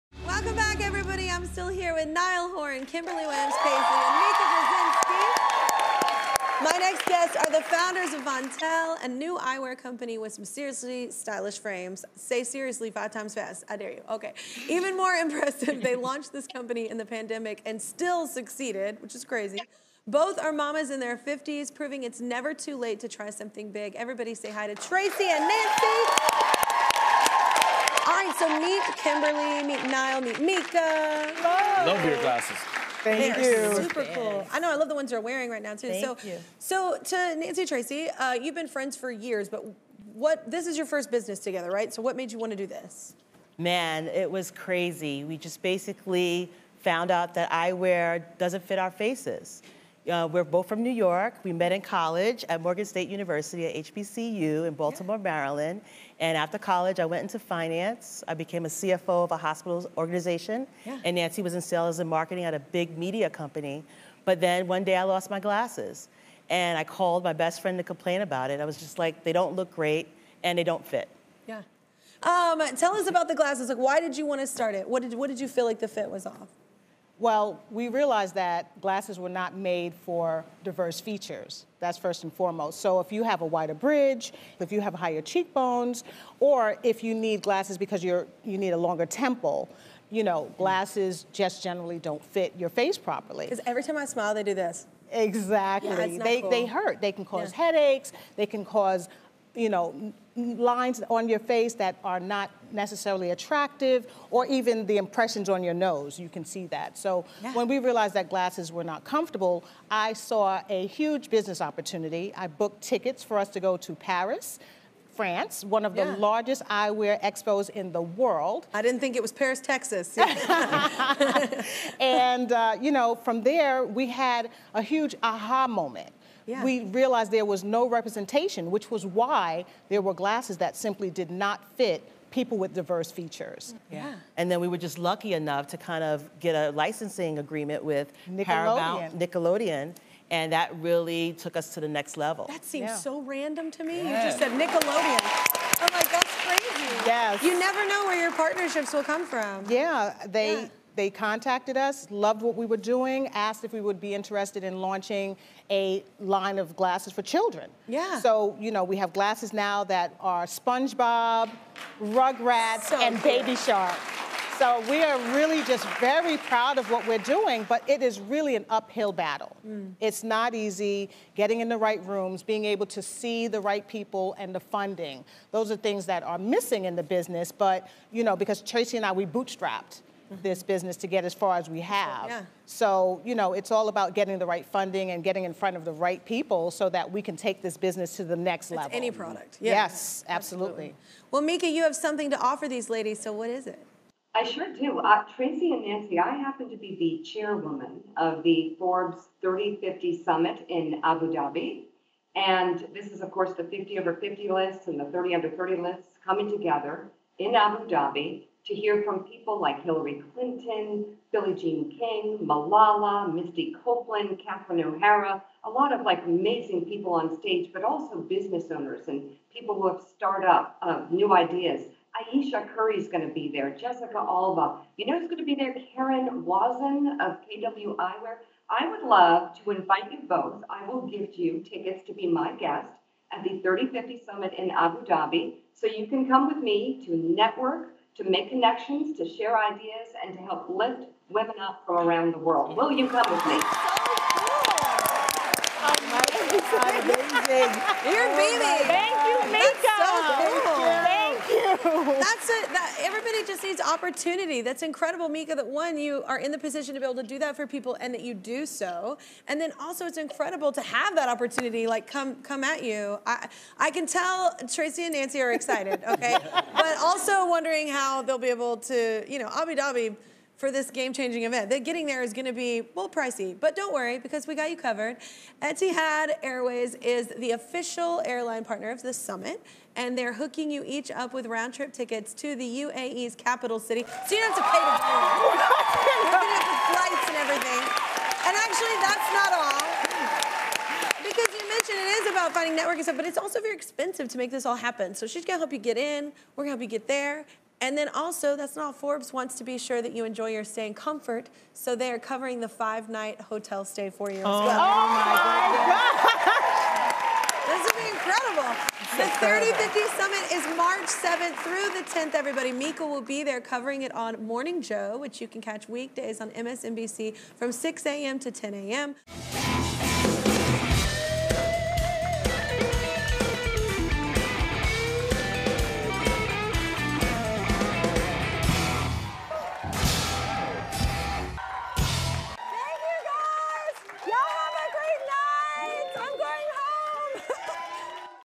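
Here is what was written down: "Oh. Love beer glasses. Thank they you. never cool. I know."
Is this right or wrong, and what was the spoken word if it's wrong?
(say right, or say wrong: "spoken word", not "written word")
wrong: "super", not "never".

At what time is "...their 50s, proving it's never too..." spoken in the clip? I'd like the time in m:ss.
0:20.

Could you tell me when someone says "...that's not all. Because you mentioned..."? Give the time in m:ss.
4:49.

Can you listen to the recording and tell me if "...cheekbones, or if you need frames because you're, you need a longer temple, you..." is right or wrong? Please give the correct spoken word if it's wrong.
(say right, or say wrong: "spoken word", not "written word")
wrong: "glasses", not "frames".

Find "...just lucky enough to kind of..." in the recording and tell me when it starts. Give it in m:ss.
2:14.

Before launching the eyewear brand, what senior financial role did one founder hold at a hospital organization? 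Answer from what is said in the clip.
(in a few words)
CFO.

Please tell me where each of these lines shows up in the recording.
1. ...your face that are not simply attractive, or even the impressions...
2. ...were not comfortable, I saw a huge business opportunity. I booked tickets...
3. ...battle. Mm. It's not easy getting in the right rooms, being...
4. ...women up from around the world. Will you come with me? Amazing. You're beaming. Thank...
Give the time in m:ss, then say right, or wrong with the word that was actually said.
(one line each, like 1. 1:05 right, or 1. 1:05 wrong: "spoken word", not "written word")
1. 1:41 wrong: "necessarily", not "simply"
2. 1:48 right
3. 2:49 right
4. 4:01 right.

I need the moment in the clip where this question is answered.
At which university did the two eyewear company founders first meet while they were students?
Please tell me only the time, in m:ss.
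0:52.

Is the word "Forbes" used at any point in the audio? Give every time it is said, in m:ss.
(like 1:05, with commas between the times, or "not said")
3:18, 4:58.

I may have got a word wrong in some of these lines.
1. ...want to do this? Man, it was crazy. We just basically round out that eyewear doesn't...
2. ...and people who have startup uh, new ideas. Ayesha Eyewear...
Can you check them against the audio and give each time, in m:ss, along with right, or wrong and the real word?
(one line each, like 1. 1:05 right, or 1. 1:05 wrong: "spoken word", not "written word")
1. 0:42 wrong: "found", not "round"
2. 3:39 wrong: "Curry", not "Eyewear".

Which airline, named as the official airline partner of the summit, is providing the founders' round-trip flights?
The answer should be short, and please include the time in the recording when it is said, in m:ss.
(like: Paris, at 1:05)
Etihad Airways, at 4:35.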